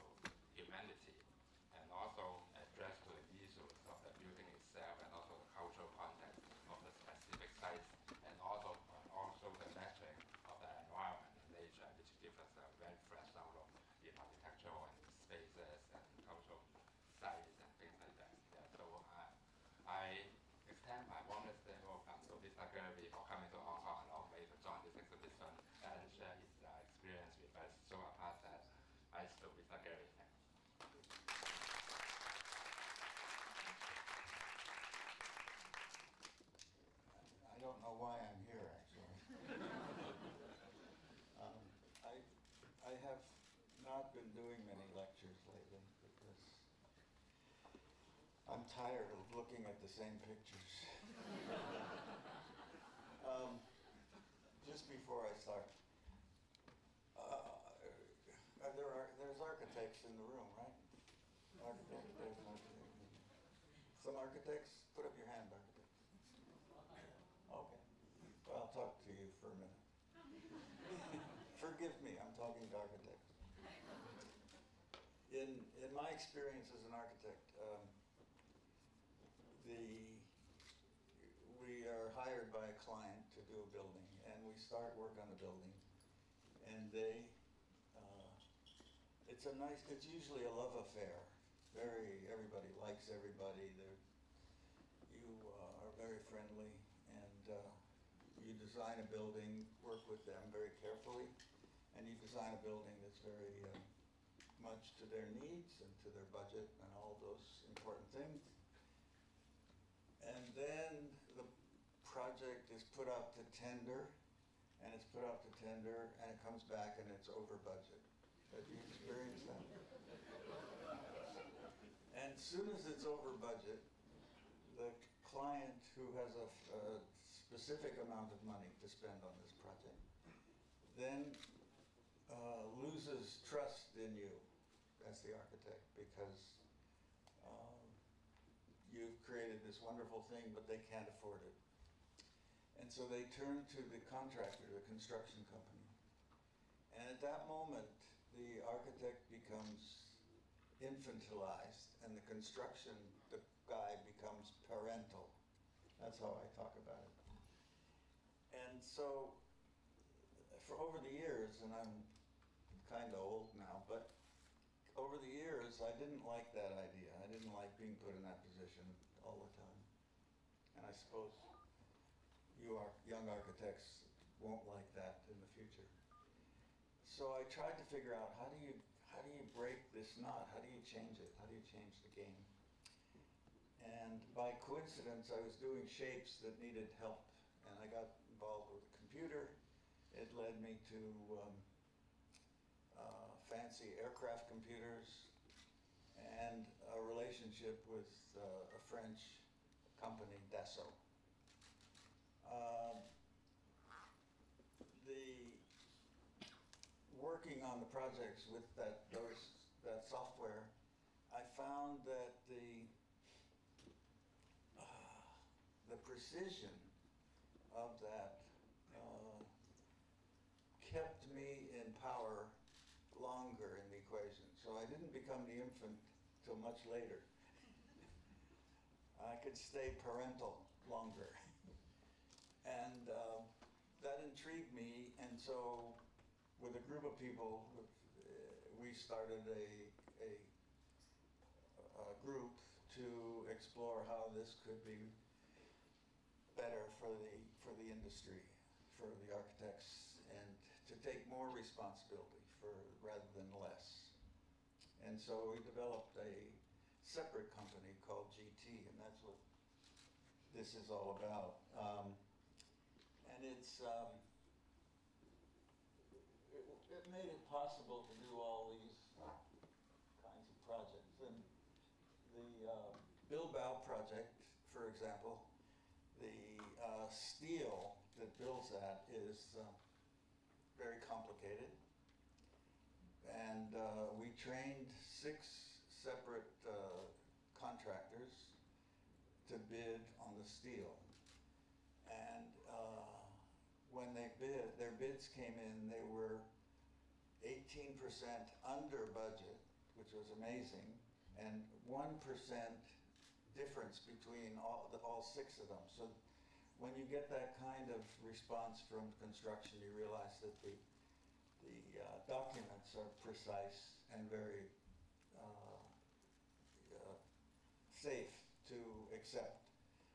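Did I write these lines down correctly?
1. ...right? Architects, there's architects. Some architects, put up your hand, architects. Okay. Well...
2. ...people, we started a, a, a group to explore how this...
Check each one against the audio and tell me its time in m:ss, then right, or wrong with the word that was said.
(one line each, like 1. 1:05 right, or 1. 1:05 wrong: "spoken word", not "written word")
1. 1:00 right
2. 3:57 right.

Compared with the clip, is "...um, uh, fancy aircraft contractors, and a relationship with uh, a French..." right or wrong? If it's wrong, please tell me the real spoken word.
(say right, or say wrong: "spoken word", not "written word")
wrong: "computers", not "contractors".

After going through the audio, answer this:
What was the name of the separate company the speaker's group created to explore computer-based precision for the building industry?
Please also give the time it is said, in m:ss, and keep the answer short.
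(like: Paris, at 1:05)
GT, at 4:18.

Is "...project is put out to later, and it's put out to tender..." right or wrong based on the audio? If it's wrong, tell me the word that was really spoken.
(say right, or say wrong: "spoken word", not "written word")
wrong: "tender", not "later".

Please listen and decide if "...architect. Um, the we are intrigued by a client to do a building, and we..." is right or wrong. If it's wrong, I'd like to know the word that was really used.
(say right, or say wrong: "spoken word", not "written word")
wrong: "hired", not "intrigued".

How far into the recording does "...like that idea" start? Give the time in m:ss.
2:46.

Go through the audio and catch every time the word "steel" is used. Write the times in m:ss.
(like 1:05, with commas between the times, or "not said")
4:37, 4:50.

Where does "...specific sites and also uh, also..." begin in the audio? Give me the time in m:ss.
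0:06.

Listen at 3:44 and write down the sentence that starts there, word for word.
So I didn't become the infant till much later.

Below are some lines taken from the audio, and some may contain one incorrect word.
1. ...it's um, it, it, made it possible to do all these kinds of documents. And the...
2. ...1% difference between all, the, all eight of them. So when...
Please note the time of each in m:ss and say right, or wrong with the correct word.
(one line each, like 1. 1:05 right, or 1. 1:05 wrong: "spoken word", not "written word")
1. 4:23 wrong: "projects", not "documents"
2. 5:01 wrong: "six", not "eight".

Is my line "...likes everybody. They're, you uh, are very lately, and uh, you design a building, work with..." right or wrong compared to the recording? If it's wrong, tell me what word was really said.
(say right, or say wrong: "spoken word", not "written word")
wrong: "friendly", not "lately".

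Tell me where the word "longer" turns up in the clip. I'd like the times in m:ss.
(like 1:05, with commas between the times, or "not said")
3:43, 3:50.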